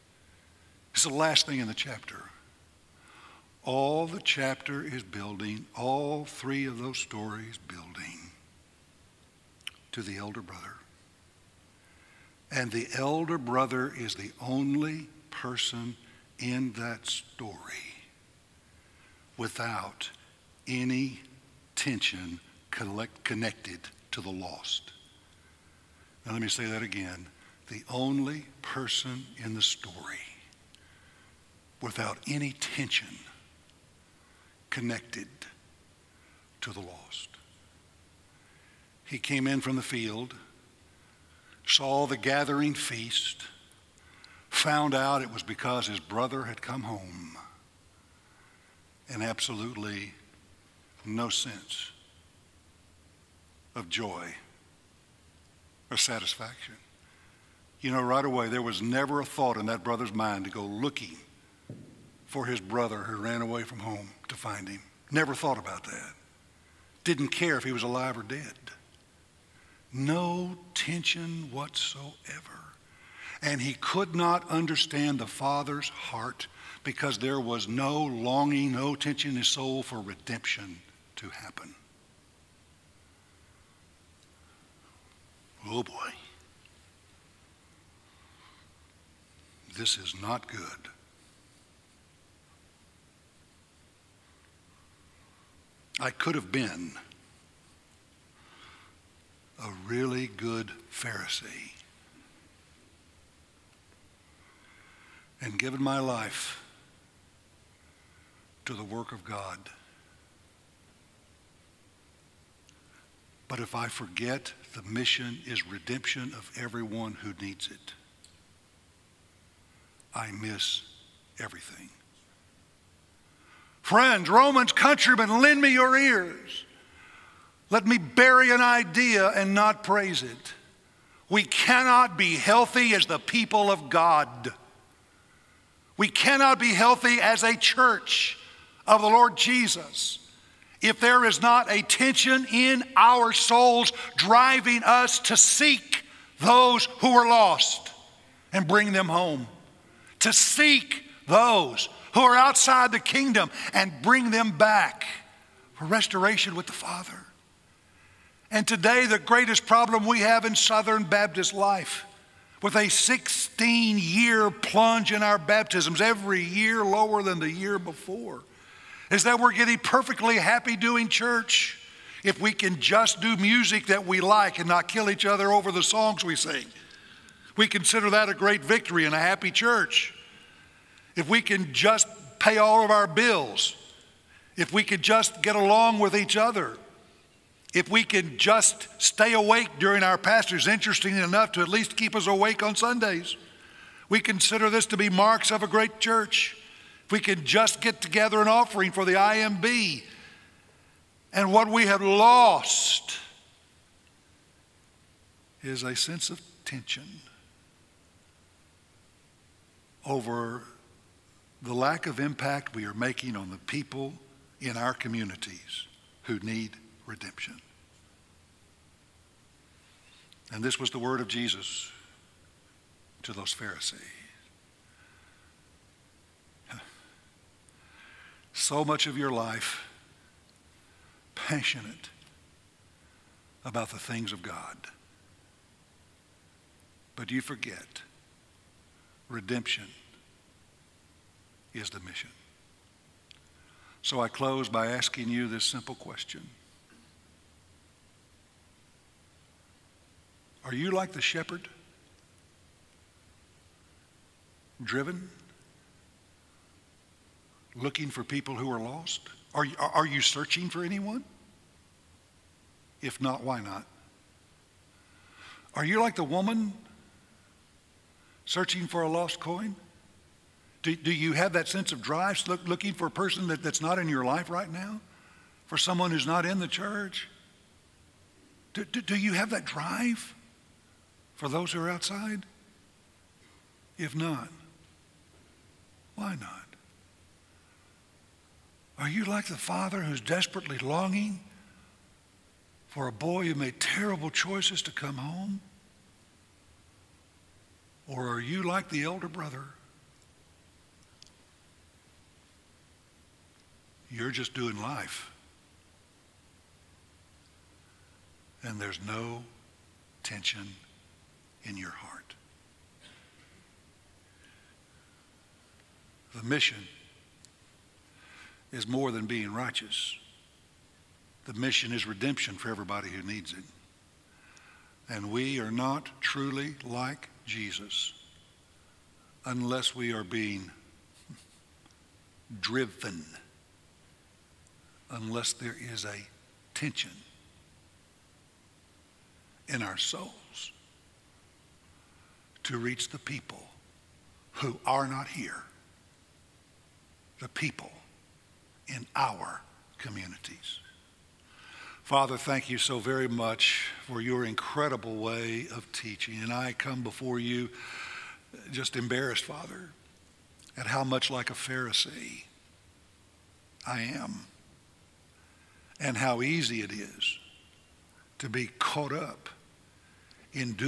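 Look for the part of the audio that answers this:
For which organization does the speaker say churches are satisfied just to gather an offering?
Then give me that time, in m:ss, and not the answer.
3:19.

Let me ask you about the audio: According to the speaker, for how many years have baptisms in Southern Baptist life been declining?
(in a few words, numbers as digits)
16 years.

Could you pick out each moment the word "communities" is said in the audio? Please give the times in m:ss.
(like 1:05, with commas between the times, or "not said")
3:34, 5:49.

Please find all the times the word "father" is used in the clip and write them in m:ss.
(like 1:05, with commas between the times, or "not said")
1:15, 2:36, 4:49, 5:52, 5:59.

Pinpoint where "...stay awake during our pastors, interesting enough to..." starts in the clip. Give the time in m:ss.
3:09.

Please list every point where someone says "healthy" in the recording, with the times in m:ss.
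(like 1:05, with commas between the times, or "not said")
2:12, 2:16.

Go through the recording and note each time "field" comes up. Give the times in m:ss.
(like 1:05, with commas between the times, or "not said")
0:39.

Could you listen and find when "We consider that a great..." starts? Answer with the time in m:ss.
2:57.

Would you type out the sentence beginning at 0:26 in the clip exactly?
Now, let me say that again the only person in the story without any tension connected to the lost.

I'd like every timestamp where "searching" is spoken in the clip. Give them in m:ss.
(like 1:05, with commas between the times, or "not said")
4:20, 4:28.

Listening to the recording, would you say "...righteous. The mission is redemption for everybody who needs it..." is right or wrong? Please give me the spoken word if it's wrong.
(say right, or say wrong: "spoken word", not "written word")
right.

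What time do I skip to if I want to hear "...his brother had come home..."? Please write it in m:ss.
0:45.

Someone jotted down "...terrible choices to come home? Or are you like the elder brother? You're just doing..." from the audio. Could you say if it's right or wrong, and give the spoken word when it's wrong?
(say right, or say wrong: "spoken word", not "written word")
right.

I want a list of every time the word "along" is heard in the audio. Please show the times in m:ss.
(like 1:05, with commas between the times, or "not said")
3:05.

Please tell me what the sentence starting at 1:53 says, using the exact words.
But if I forget, the mission is redemption of everyone who needs it.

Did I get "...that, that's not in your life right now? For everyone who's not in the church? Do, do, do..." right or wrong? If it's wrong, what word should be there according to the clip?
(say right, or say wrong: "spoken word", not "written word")
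wrong: "someone", not "everyone".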